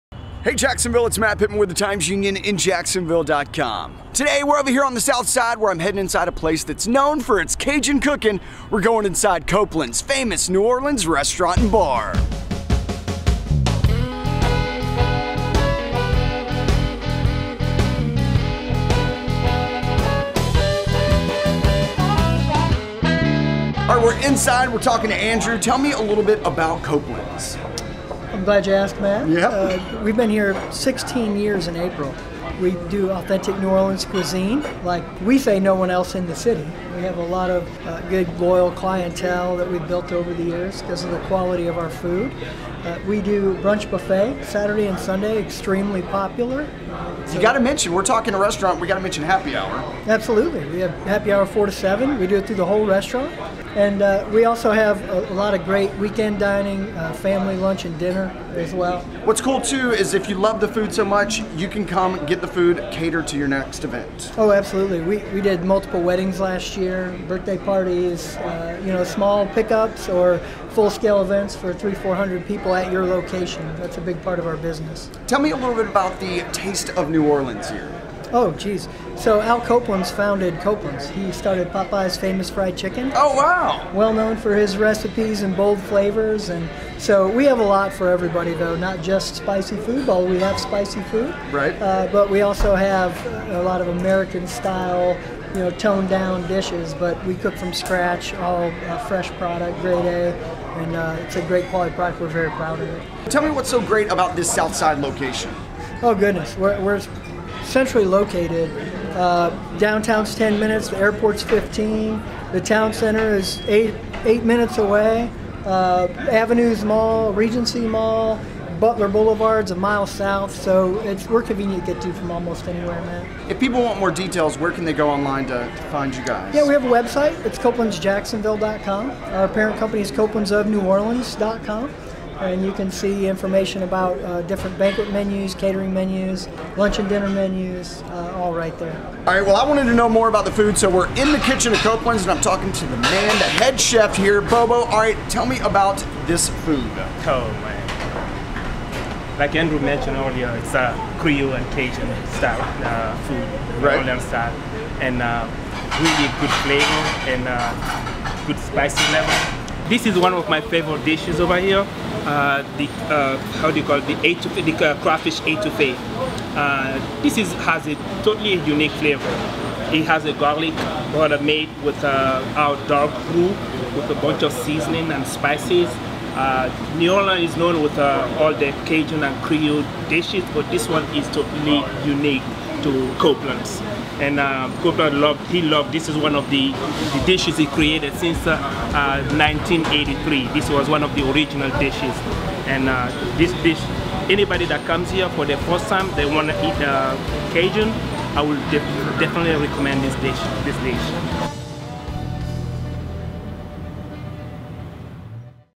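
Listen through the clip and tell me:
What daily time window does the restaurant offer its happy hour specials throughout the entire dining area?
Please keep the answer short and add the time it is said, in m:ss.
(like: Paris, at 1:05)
4 to 7, at 0:51.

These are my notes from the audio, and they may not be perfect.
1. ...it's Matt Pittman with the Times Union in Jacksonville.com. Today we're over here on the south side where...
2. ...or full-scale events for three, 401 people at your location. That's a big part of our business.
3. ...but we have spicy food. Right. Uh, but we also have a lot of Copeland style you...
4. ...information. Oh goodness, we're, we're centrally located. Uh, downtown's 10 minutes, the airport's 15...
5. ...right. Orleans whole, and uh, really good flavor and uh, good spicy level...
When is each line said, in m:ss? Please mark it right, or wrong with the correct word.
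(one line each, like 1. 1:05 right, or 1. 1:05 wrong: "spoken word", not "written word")
1. 0:01 right
2. 1:10 wrong: "400", not "401"
3. 1:30 wrong: "American", not "Copeland"
4. 1:44 wrong: "location", not "information"
5. 2:33 wrong: "style", not "whole".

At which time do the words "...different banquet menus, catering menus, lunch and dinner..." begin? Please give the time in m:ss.
2:14.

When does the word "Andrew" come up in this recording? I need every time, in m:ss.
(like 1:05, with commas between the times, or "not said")
0:25, 2:29.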